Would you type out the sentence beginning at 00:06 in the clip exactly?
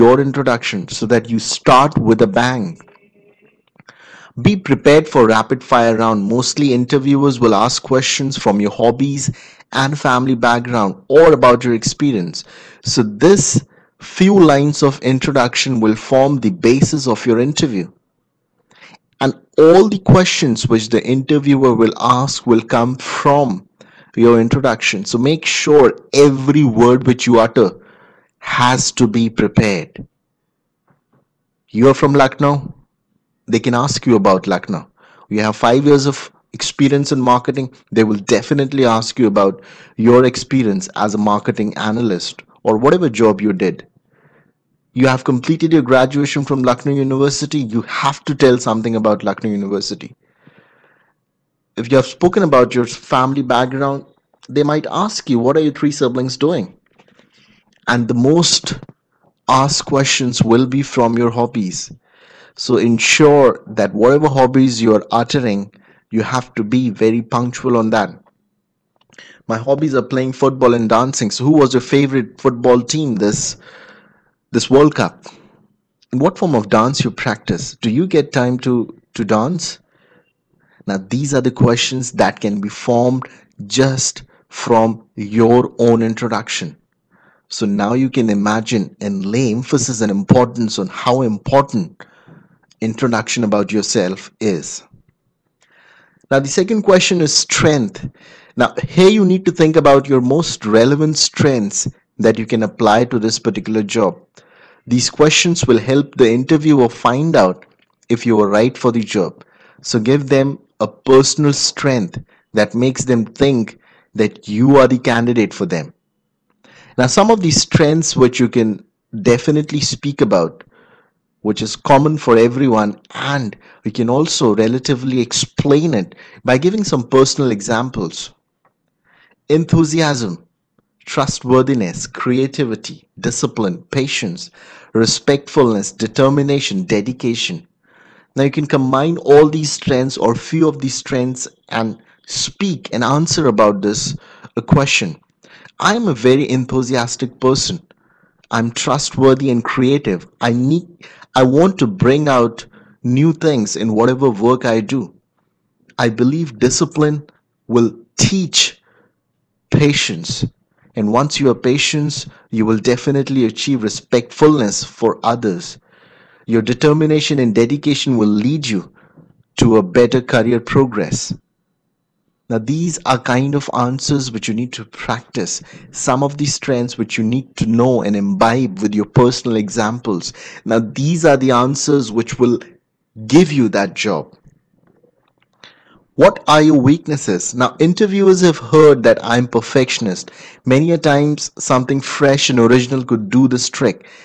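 Mostly interviewers will ask questions from your hobbies and family background or about your experience.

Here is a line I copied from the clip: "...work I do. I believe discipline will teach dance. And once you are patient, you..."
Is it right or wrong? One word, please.
wrong.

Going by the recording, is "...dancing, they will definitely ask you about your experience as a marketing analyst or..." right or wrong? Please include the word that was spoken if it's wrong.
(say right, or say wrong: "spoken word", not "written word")
wrong: "marketing", not "dancing".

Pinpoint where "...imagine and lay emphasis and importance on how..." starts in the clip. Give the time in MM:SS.
01:28.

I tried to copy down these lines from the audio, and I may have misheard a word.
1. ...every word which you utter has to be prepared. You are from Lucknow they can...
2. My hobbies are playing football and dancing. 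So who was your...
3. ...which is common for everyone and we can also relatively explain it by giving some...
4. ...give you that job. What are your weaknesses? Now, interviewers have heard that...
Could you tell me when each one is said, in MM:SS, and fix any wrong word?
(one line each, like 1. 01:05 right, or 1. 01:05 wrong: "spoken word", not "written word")
1. 00:26 right
2. 01:09 right
3. 02:01 right
4. 03:03 right.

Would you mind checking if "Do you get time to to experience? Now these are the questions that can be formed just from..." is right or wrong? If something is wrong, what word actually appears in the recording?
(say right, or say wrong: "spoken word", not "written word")
wrong: "dance", not "experience".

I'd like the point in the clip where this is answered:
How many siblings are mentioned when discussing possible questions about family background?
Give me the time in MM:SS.
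00:55.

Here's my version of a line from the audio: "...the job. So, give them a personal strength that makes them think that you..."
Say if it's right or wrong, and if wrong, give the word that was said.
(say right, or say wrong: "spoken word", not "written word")
right.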